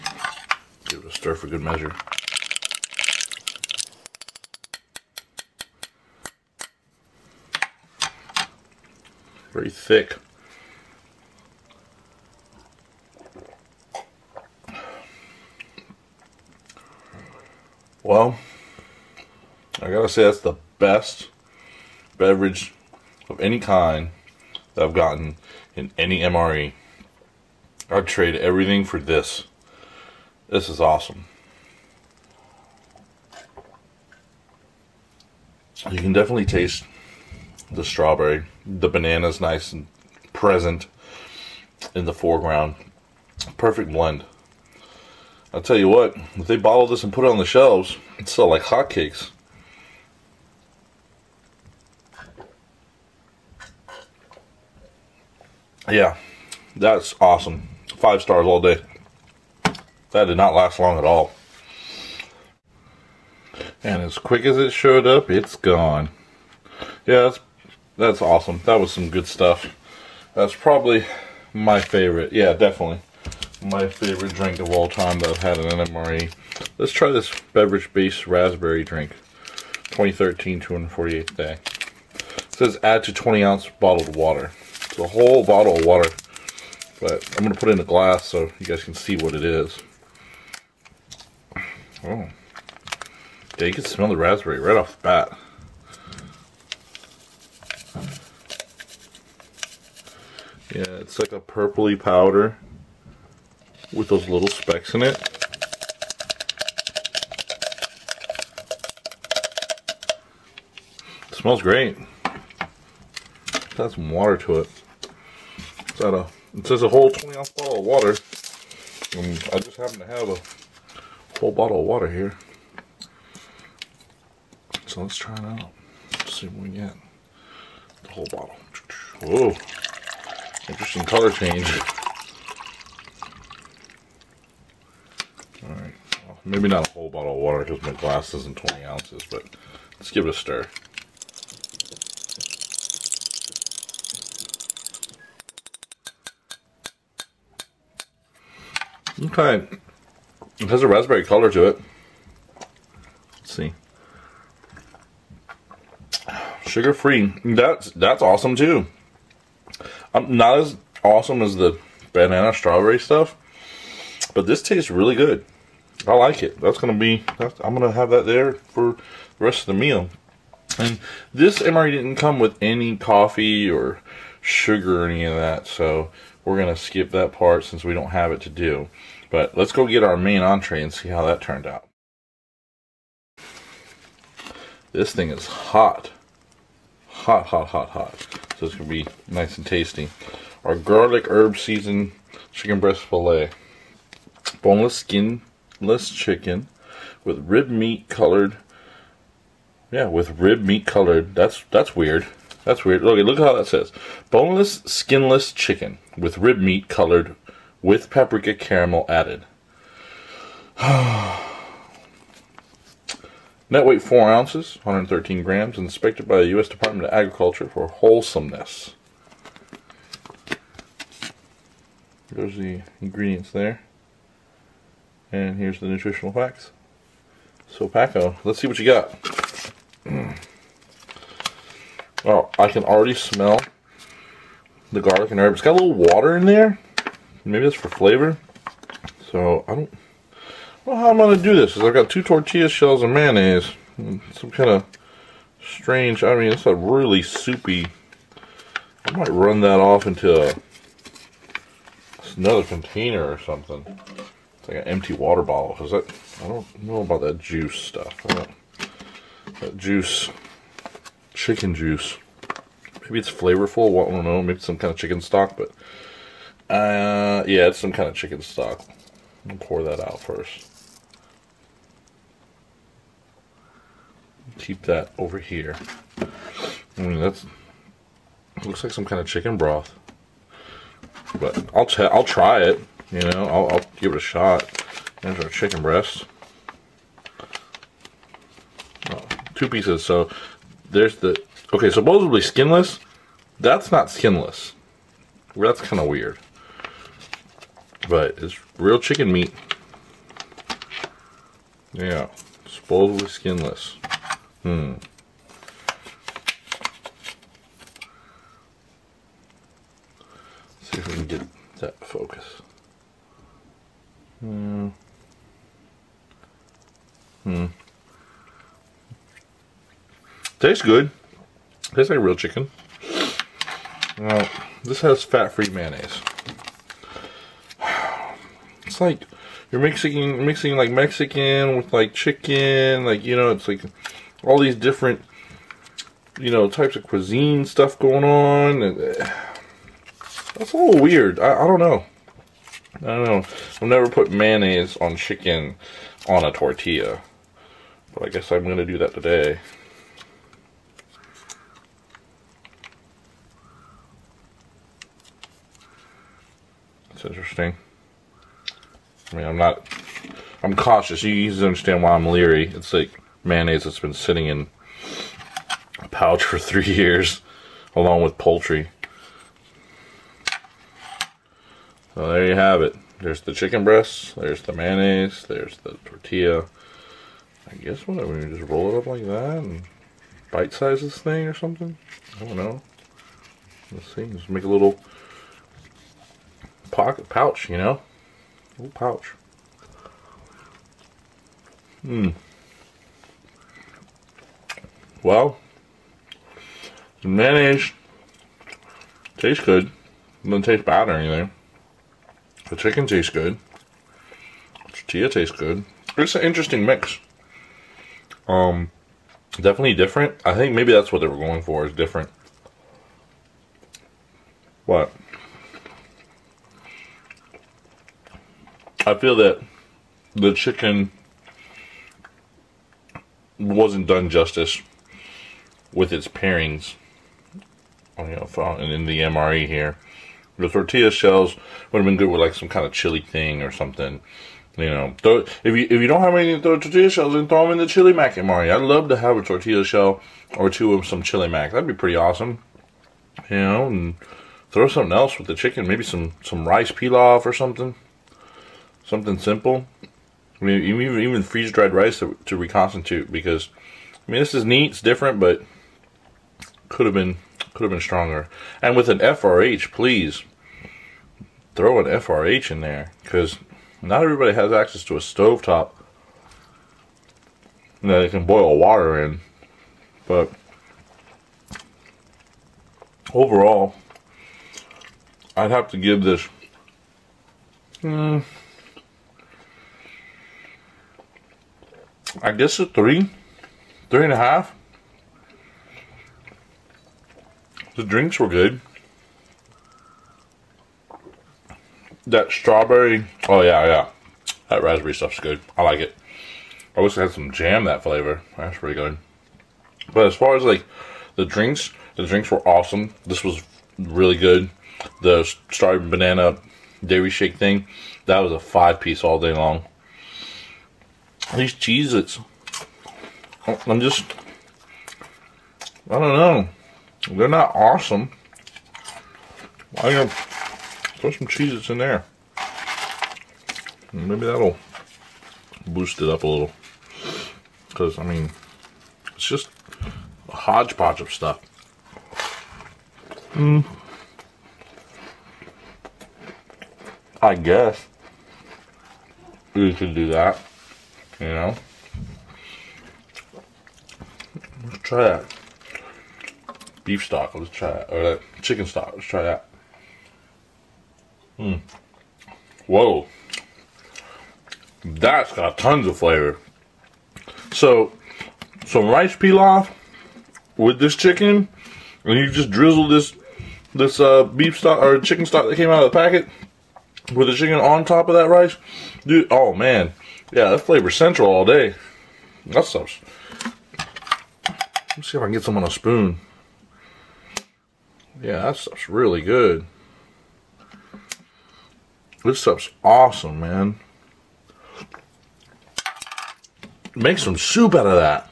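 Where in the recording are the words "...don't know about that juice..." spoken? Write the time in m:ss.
4:16.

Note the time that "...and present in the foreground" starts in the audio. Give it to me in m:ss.
0:39.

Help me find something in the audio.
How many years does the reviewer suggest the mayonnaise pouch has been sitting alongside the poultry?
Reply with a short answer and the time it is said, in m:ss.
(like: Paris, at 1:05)
Three years, at 6:06.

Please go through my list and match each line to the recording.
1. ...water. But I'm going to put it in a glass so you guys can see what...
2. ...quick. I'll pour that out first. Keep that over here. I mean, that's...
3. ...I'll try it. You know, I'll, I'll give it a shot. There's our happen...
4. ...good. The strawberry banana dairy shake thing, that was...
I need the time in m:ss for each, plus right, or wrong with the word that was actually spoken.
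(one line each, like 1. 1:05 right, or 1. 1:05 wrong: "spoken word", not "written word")
1. 1:25 right
2. 4:28 wrong: "stock", not "quick"
3. 4:42 wrong: "chicken", not "happen"
4. 8:24 right.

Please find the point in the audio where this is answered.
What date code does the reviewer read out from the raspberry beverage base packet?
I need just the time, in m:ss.
1:19.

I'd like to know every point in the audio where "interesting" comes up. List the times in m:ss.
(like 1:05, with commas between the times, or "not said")
2:10, 5:57, 6:46.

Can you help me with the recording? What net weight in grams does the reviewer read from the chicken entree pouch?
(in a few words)
113 grams.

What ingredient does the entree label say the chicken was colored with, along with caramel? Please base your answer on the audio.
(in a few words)
Paprika.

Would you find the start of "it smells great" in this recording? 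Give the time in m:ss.
1:51.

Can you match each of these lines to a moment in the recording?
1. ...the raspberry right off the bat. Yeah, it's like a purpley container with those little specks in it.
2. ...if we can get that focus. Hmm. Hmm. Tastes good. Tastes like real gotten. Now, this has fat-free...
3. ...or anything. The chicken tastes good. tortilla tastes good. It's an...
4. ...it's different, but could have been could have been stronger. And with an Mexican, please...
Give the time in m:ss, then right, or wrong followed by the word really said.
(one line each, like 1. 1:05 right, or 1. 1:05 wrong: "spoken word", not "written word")
1. 1:34 wrong: "powder", not "container"
2. 5:10 wrong: "chicken", not "gotten"
3. 6:41 right
4. 7:34 wrong: "FRH", not "Mexican".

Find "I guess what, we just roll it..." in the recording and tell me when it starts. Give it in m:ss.
6:17.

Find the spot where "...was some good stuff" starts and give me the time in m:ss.
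1:08.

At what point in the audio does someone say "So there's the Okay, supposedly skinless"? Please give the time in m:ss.
4:50.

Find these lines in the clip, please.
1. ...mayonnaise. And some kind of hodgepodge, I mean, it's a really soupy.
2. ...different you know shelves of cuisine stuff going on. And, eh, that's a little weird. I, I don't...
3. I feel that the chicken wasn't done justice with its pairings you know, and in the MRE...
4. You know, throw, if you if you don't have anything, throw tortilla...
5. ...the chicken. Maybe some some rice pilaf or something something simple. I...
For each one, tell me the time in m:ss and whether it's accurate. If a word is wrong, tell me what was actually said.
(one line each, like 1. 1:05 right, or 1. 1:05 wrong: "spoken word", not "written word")
1. 4:03 wrong: "strange", not "hodgepodge"
2. 5:34 wrong: "types", not "shelves"
3. 6:59 right
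4. 7:14 right
5. 7:25 right.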